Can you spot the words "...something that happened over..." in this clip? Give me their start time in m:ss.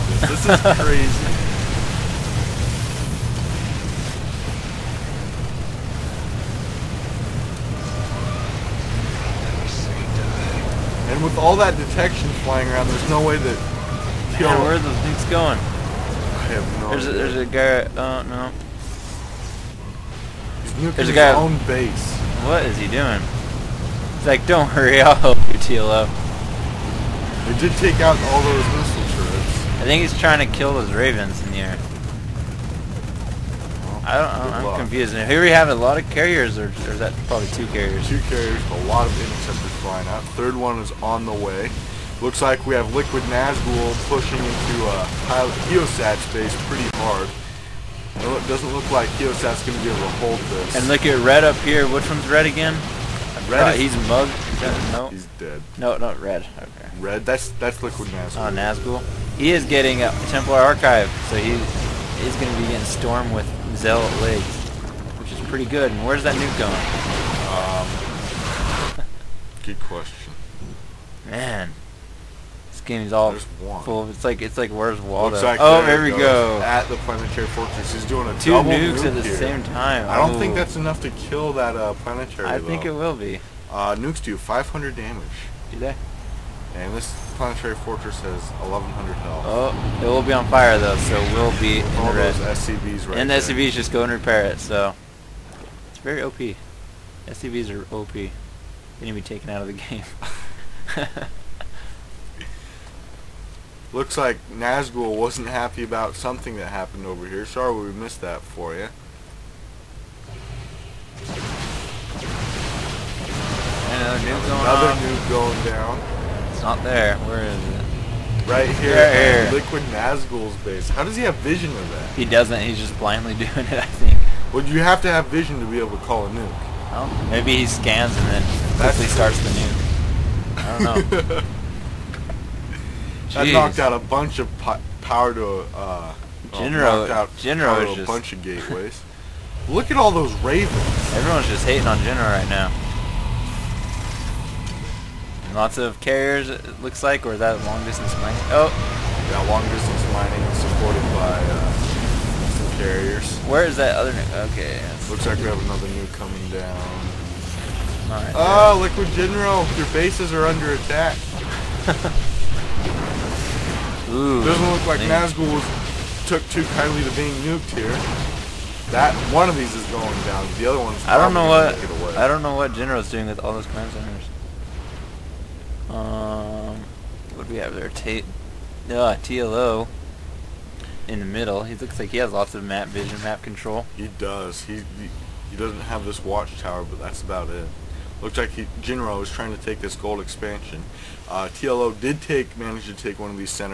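1:46.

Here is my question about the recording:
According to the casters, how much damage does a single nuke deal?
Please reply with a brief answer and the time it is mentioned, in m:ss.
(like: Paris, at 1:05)
500, at 1:24.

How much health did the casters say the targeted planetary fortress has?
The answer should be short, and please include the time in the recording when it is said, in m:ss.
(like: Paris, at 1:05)
1,100, at 1:28.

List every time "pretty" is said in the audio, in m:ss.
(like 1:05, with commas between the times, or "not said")
0:46, 1:05.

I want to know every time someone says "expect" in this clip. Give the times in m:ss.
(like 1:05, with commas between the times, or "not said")
not said.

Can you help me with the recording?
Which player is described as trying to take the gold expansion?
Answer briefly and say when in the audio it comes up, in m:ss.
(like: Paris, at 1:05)
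Jinro, at 3:08.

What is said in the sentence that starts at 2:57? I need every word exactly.
we have their T uh, TLO in the middle.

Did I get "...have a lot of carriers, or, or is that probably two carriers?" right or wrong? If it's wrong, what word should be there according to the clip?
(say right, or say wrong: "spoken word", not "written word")
right.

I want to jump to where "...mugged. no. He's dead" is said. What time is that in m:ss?
0:54.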